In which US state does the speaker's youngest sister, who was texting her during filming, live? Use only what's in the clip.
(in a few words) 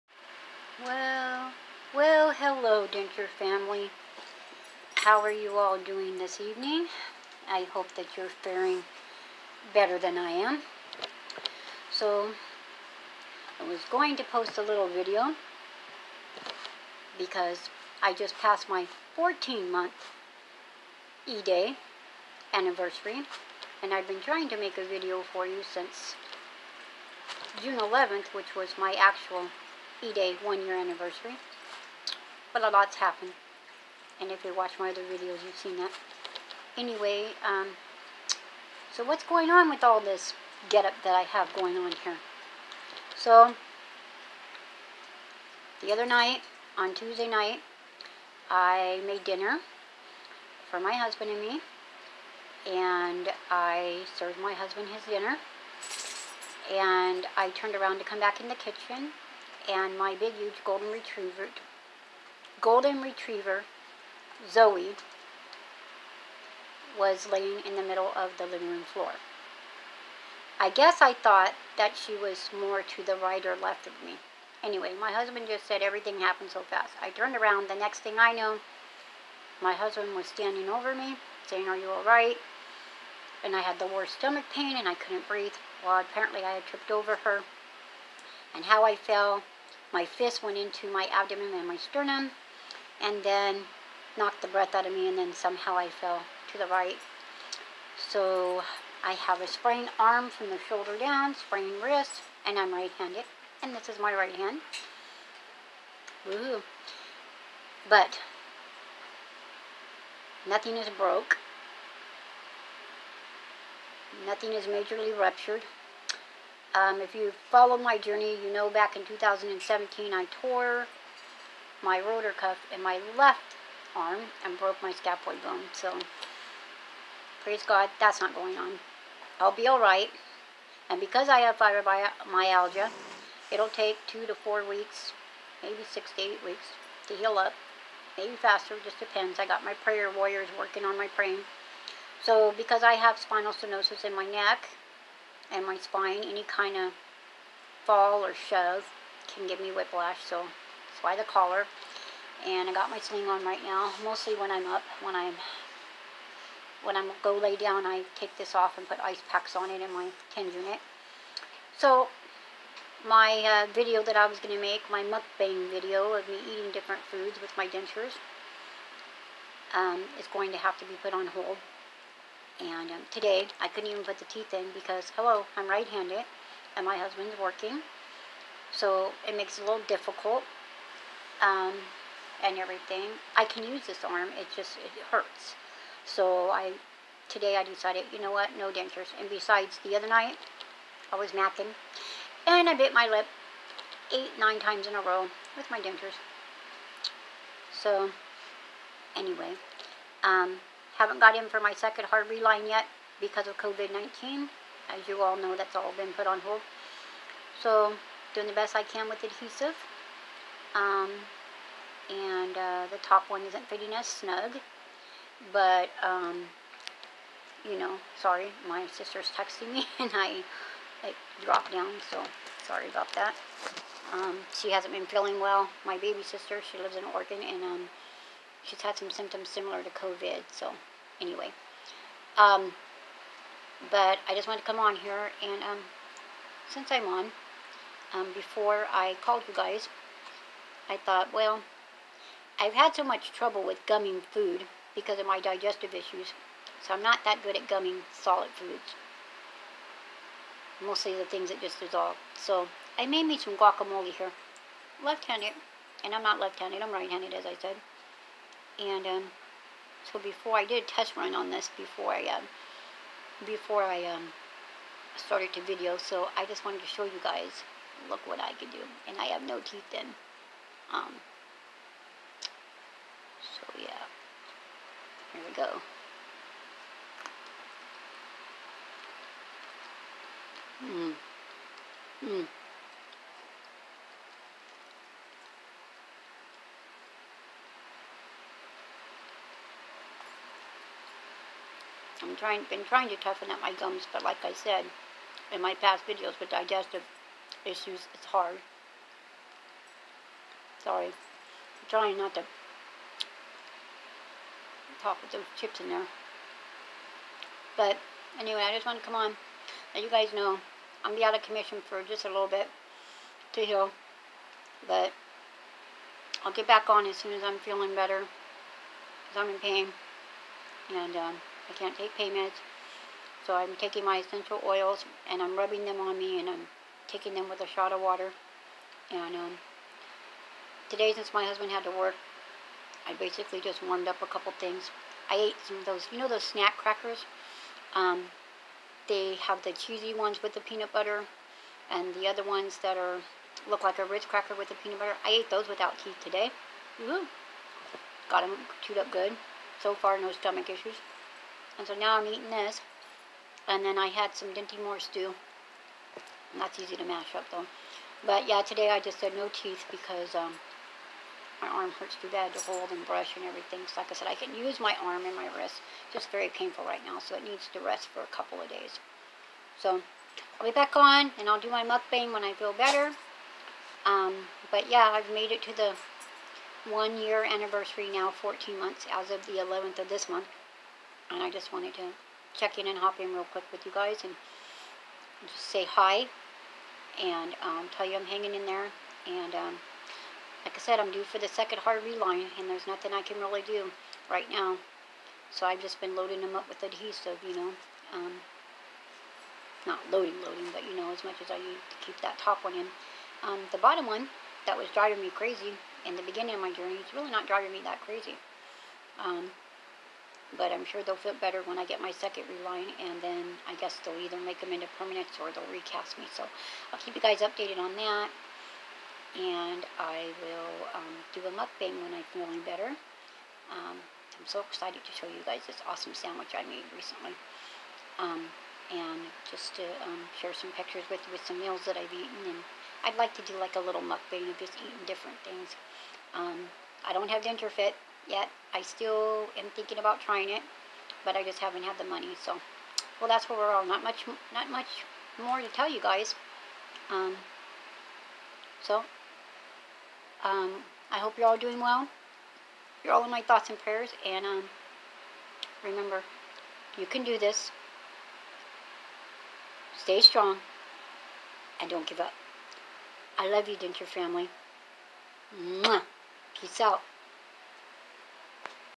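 Oregon.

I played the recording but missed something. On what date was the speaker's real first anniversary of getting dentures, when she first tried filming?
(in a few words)
June 11th.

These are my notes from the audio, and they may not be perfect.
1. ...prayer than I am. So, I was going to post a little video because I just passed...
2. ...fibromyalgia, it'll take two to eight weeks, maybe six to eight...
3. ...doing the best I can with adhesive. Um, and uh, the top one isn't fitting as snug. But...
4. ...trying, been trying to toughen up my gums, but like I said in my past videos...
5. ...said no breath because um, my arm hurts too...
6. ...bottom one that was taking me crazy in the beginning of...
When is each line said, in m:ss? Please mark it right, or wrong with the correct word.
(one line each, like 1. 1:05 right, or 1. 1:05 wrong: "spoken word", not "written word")
1. 0:09 wrong: "better", not "prayer"
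2. 2:11 wrong: "four", not "eight"
3. 3:28 right
4. 4:52 right
5. 5:59 wrong: "teeth", not "breath"
6. 6:43 wrong: "driving", not "taking".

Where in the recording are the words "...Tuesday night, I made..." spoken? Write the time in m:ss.
0:46.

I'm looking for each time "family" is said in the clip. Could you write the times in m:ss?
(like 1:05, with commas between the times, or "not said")
0:03, 7:44.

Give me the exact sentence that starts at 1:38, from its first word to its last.
So I have a sprained arm from the shoulder down, sprained wrist, and I'm right-handed.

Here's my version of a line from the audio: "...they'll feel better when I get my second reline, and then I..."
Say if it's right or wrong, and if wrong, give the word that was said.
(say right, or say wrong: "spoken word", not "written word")
right.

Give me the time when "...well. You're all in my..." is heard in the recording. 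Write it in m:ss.
7:31.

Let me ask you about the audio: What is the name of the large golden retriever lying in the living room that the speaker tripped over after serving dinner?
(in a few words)
Zoe.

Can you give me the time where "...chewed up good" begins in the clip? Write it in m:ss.
5:48.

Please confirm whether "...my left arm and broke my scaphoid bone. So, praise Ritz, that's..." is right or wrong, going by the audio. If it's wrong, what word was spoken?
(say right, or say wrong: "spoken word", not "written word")
wrong: "God", not "Ritz".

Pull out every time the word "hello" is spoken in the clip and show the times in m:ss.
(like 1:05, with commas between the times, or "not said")
0:02, 2:55.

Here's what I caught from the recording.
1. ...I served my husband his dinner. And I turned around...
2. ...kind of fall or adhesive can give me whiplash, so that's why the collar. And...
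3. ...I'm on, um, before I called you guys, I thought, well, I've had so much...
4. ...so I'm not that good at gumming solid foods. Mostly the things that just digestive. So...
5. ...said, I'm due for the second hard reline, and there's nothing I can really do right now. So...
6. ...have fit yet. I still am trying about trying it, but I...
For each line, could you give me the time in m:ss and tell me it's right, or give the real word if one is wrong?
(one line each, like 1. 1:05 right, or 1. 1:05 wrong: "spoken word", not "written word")
1. 0:53 right
2. 2:26 wrong: "shove", not "adhesive"
3. 3:56 right
4. 4:06 wrong: "dissolve", not "digestive"
5. 6:30 right
6. 7:17 wrong: "thinking", not "trying".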